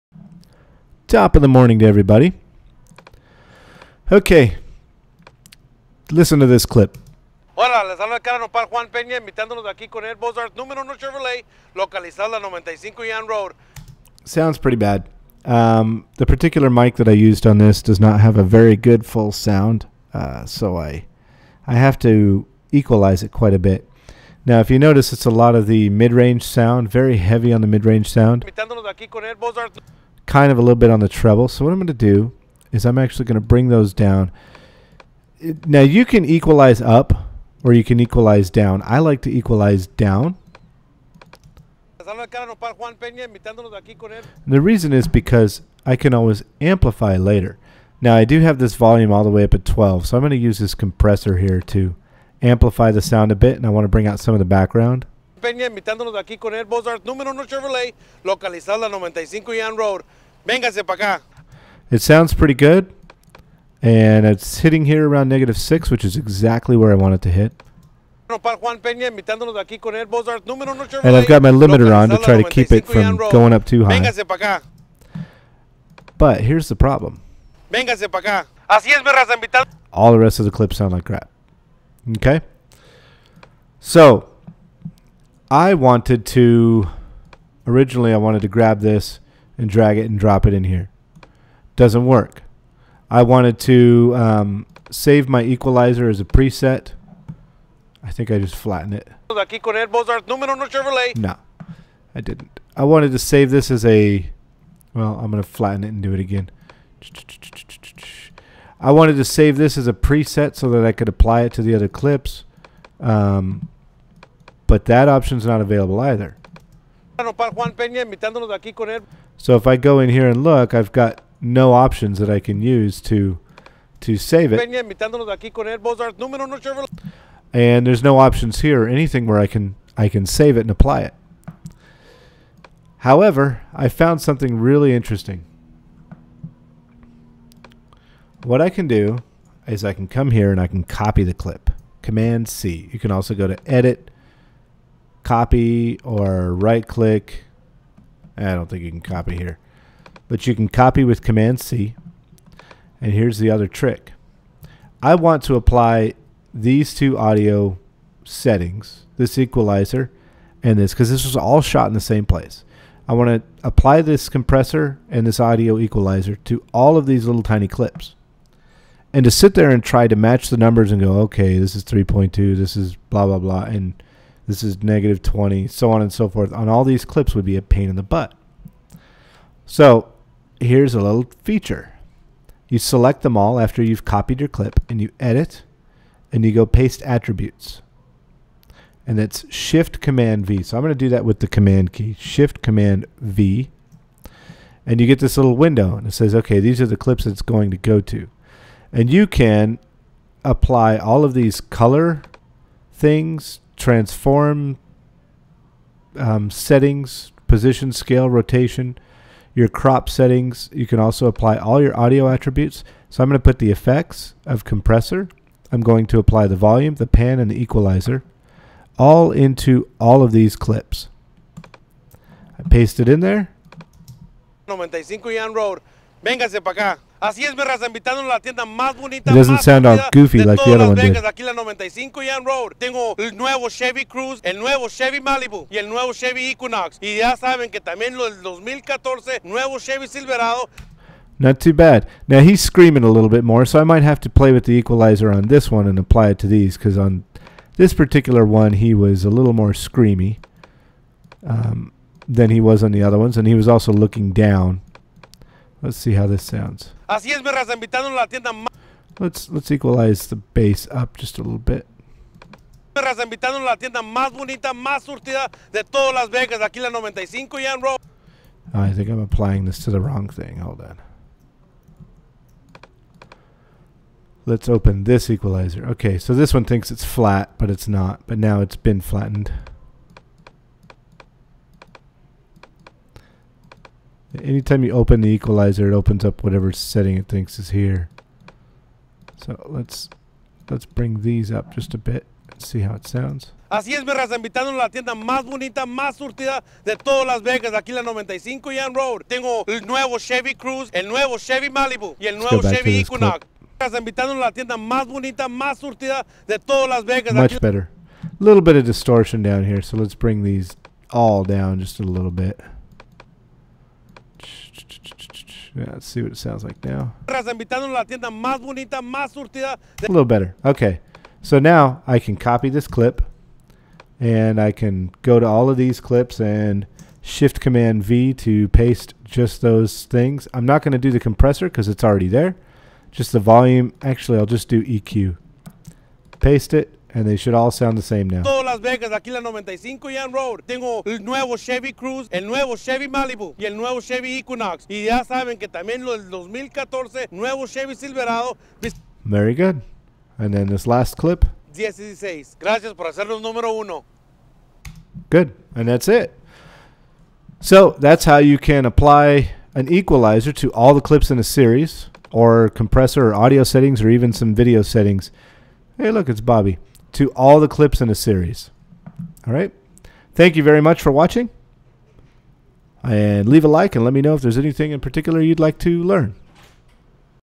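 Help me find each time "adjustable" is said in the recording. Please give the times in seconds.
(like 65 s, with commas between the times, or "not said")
not said.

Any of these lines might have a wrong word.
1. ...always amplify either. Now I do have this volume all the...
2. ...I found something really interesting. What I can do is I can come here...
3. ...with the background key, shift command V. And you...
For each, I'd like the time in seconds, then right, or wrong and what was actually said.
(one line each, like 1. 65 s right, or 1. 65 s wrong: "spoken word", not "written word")
1. 46 s wrong: "later", not "either"
2. 133 s right
3. 191 s wrong: "command", not "background".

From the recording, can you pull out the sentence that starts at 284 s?
Anytime you open the equalizer, it opens up whatever setting it thinks is here.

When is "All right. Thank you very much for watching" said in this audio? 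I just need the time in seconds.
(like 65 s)
369 s.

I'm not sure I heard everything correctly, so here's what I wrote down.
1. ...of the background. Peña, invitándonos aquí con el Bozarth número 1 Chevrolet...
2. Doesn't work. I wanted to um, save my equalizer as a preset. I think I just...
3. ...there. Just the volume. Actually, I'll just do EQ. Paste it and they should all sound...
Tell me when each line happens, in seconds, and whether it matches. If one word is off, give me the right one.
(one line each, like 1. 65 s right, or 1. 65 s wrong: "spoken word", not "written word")
1. 54 s right
2. 91 s right
3. 332 s right.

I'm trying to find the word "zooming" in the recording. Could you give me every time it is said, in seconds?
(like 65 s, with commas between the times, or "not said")
not said.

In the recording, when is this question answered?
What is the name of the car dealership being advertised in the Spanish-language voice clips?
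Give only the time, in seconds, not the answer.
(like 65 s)
10 s.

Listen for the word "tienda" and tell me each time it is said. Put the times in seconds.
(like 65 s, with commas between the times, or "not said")
228 s, 258 s, 263 s, 294 s, 304 s.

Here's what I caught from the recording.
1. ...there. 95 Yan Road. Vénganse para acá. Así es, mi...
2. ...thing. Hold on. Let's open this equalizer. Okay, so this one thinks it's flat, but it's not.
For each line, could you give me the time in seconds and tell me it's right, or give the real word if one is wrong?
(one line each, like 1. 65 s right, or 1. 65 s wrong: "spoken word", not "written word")
1. 223 s right
2. 270 s right.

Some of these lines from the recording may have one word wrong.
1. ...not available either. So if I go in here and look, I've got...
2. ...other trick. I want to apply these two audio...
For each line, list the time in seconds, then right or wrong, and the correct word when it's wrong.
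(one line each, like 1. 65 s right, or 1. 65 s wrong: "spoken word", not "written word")
1. 115 s right
2. 153 s right.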